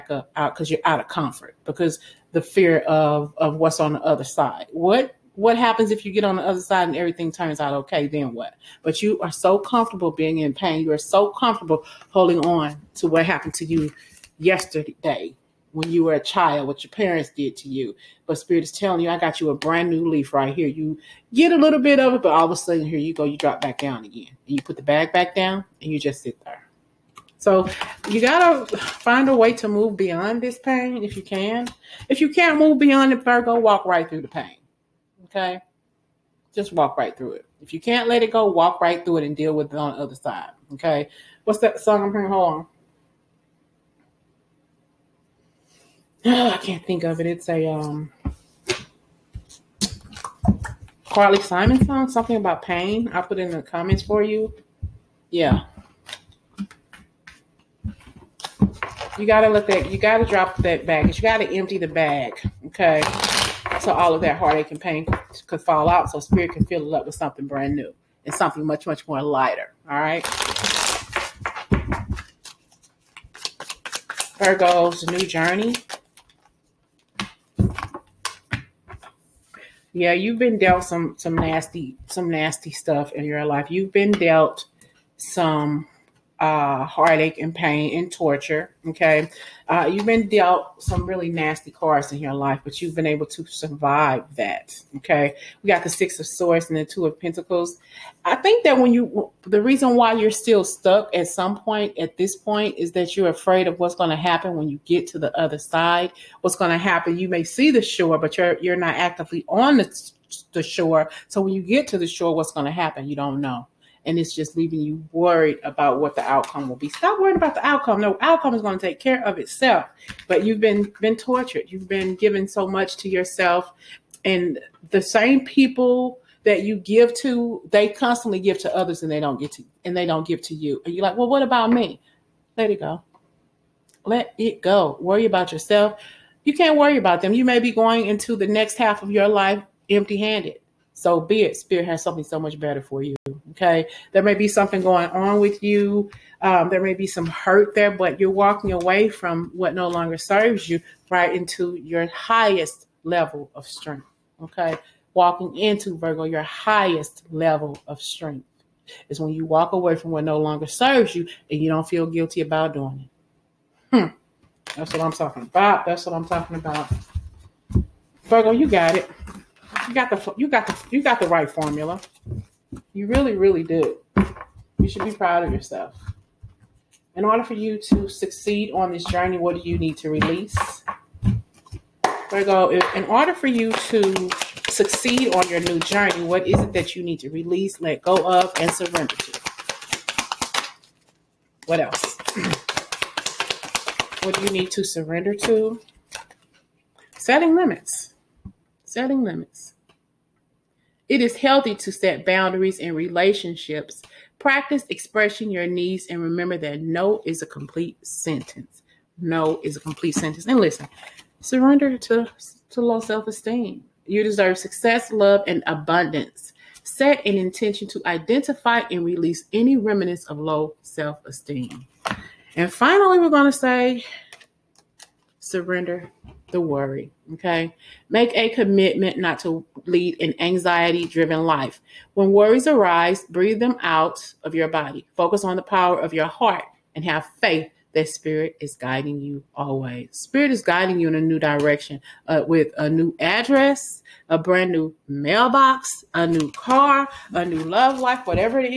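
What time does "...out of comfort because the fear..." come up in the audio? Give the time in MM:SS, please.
00:00.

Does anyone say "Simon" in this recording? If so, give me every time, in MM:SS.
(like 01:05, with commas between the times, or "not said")
00:51.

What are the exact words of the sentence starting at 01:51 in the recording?
So when you get to the shore, what's going to happen?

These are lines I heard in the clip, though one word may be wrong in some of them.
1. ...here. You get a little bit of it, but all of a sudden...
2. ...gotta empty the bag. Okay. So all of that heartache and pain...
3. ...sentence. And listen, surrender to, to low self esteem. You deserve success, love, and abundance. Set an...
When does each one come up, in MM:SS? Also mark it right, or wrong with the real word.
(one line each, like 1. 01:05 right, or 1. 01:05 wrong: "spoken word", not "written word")
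1. 00:20 right
2. 01:01 right
3. 03:30 right.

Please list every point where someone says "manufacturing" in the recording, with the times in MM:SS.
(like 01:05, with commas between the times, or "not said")
not said.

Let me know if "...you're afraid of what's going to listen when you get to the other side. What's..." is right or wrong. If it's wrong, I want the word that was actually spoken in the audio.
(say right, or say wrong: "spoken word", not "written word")
wrong: "happen", not "listen".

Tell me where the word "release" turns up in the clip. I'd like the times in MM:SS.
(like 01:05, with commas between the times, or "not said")
03:00, 03:07, 03:39.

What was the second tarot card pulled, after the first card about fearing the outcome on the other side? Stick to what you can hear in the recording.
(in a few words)
Two of Pentacles.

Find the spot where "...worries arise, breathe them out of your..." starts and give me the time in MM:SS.
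03:52.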